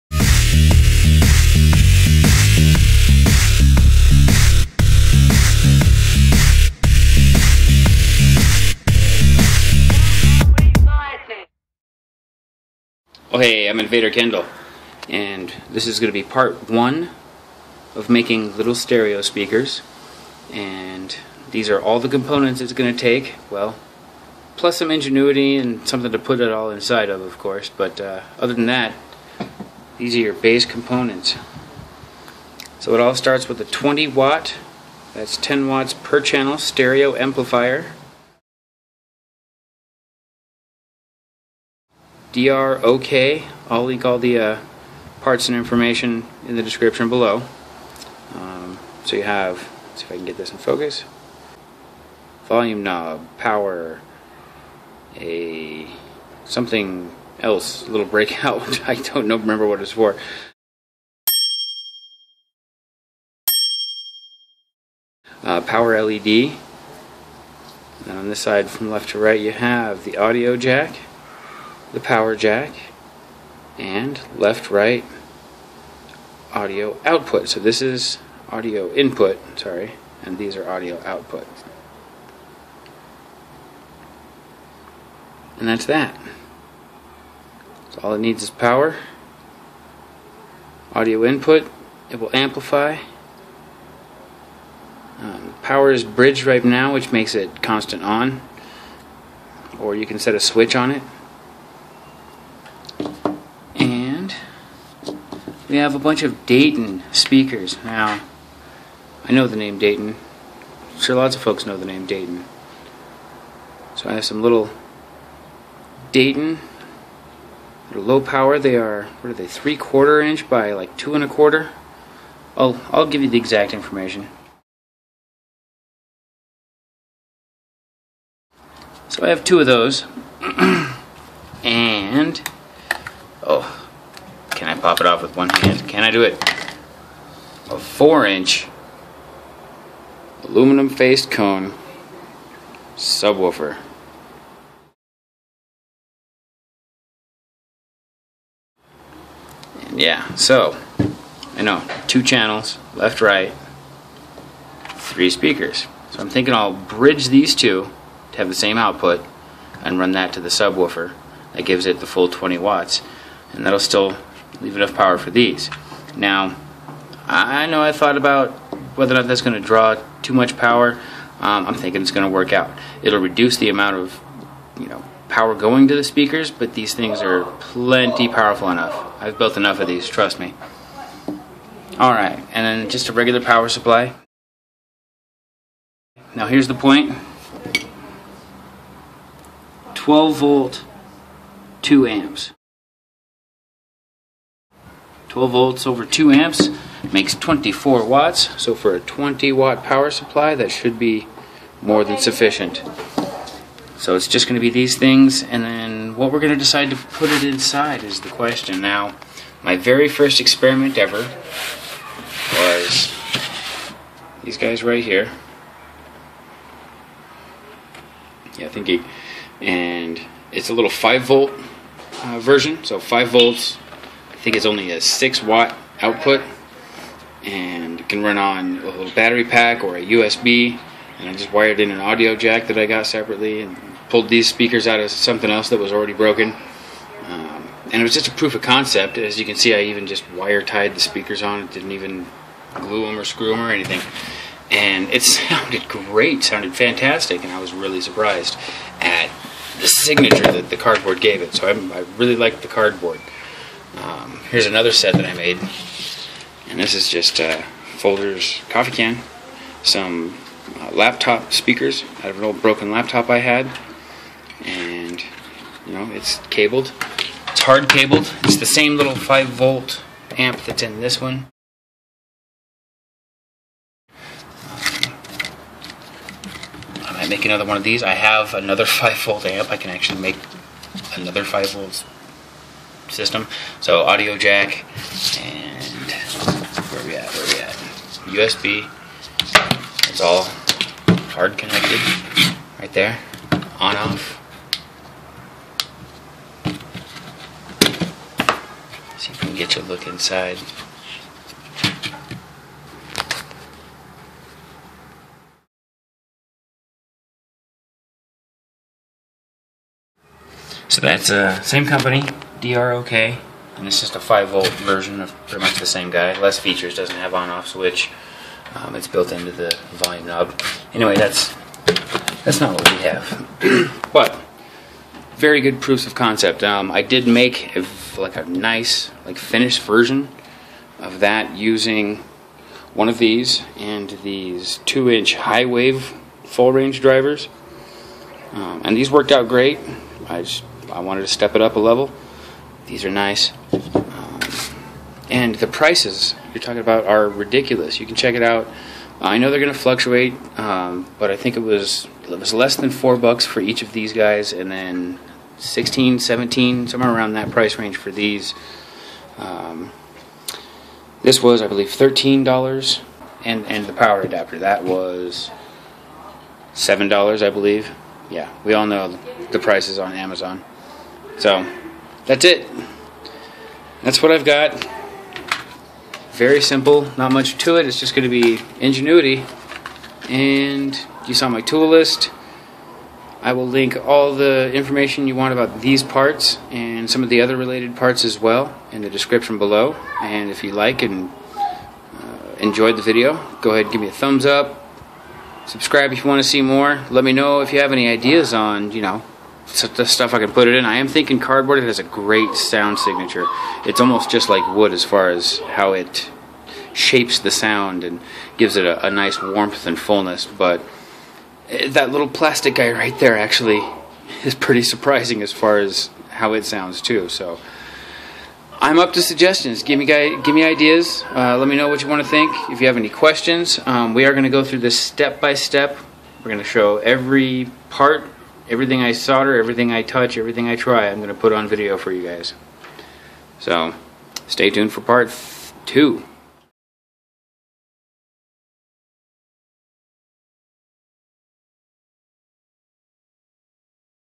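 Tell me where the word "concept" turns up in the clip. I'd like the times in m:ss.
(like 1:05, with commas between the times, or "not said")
3:58, 5:26.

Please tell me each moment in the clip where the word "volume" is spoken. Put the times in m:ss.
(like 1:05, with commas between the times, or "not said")
0:52, 5:19.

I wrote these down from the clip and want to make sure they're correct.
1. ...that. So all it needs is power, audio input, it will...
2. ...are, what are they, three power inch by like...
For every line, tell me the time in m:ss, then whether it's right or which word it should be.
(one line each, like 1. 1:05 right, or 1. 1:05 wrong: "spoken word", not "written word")
1. 1:25 right
2. 1:58 wrong: "quarter", not "power".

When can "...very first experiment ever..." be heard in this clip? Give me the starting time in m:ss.
3:29.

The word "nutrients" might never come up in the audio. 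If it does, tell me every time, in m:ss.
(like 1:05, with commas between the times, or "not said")
not said.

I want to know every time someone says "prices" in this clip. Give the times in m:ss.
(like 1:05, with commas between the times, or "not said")
5:45, 5:57, 6:09.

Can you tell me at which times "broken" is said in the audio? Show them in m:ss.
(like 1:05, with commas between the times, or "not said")
3:56, 4:22.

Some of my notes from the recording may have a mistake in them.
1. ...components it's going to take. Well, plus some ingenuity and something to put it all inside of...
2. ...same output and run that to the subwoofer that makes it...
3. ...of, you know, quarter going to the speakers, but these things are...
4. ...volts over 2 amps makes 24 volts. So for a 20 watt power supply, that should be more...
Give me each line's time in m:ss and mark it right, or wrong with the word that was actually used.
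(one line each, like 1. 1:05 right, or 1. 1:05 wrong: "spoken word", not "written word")
1. 0:22 right
2. 2:38 wrong: "gives", not "makes"
3. 2:53 wrong: "power", not "quarter"
4. 3:15 wrong: "watts", not "volts".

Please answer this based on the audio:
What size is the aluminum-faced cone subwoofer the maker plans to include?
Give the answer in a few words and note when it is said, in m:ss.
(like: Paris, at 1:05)
4 inch, at 2:17.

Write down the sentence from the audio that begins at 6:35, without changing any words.
Subscribe if you want to see more.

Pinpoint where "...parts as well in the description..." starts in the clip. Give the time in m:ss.
6:27.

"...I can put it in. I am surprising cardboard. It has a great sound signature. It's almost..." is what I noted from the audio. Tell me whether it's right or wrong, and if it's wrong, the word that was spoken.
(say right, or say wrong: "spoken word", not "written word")
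wrong: "thinking", not "surprising".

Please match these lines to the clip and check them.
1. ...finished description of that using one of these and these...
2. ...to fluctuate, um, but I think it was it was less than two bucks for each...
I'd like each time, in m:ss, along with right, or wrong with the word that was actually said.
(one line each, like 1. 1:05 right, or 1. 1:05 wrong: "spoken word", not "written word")
1. 5:29 wrong: "version", not "description"
2. 5:49 wrong: "four", not "two".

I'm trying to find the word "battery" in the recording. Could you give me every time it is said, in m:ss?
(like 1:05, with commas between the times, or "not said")
3:49.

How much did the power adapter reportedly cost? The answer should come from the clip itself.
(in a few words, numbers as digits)
$7.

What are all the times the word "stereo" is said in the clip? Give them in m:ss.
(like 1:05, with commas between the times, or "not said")
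0:18, 0:36.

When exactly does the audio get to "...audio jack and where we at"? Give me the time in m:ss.
4:44.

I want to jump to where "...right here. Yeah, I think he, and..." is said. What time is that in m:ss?
3:34.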